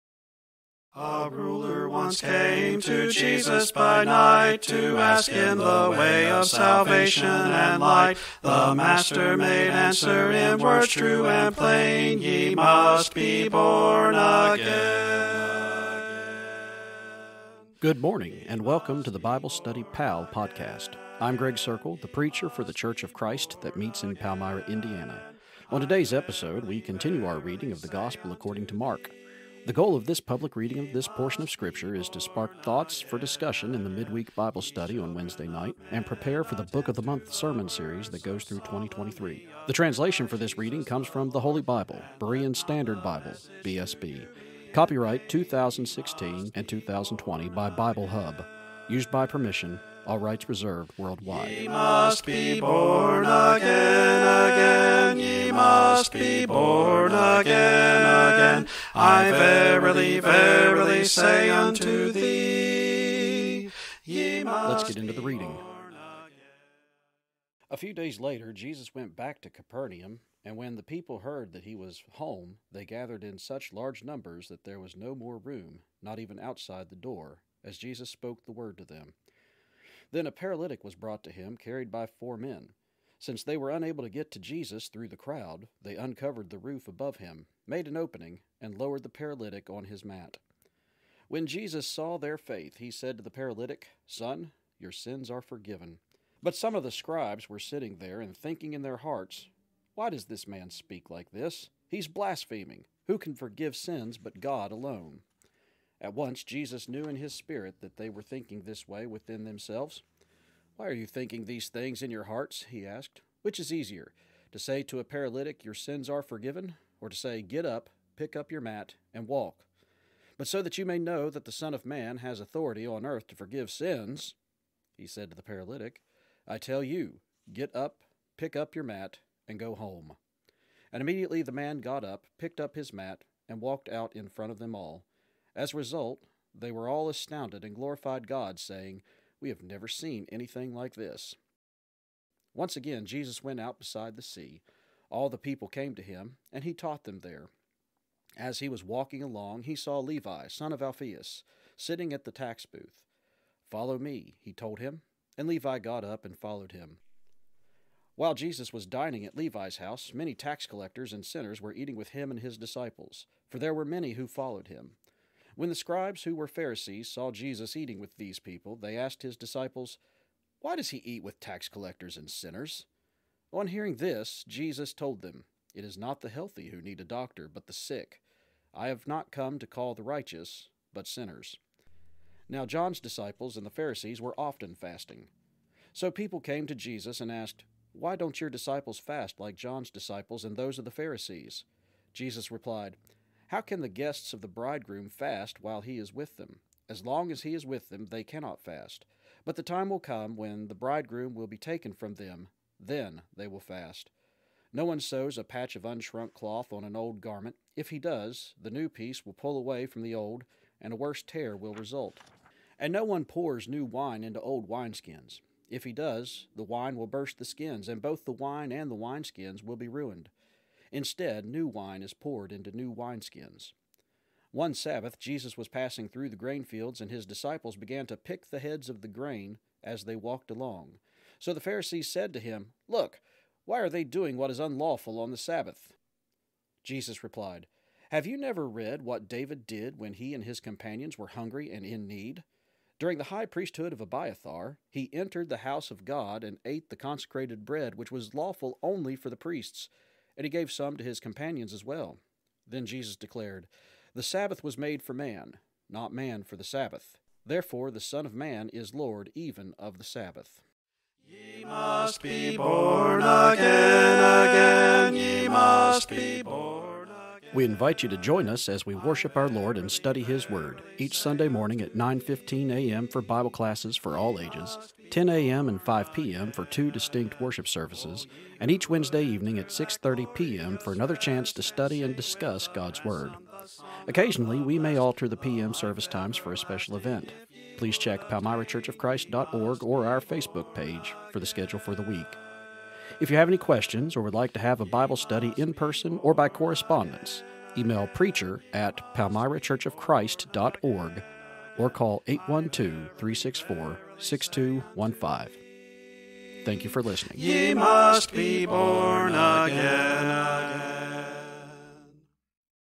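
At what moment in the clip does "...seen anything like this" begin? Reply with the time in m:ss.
2:19.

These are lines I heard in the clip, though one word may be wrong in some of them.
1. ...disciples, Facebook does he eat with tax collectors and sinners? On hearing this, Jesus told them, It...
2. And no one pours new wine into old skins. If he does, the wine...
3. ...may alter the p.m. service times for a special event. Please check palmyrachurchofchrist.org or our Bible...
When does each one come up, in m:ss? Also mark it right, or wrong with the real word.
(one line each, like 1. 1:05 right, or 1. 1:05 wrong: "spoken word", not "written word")
1. 2:49 wrong: "Why", not "Facebook"
2. 3:32 wrong: "wineskins", not "skins"
3. 4:44 wrong: "Facebook", not "Bible".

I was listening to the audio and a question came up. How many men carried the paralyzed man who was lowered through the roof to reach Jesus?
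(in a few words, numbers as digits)
4.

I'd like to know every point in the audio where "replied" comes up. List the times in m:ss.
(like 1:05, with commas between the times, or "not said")
3:12, 3:57.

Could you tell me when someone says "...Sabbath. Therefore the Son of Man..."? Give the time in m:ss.
4:16.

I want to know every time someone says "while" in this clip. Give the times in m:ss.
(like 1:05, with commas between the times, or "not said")
2:38, 3:15.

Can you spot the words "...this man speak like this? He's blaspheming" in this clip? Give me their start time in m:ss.
1:40.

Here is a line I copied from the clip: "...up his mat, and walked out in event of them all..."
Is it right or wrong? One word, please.
wrong.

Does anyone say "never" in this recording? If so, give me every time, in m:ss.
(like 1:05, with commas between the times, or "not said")
2:19, 3:58.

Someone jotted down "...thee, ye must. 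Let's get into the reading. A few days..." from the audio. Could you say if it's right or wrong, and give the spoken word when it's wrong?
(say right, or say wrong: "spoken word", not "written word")
right.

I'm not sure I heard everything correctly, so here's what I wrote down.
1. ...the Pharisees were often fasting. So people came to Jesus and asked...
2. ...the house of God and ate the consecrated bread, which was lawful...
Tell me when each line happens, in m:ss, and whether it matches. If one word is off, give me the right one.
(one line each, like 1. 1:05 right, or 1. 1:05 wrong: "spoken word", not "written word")
1. 3:03 right
2. 4:05 right.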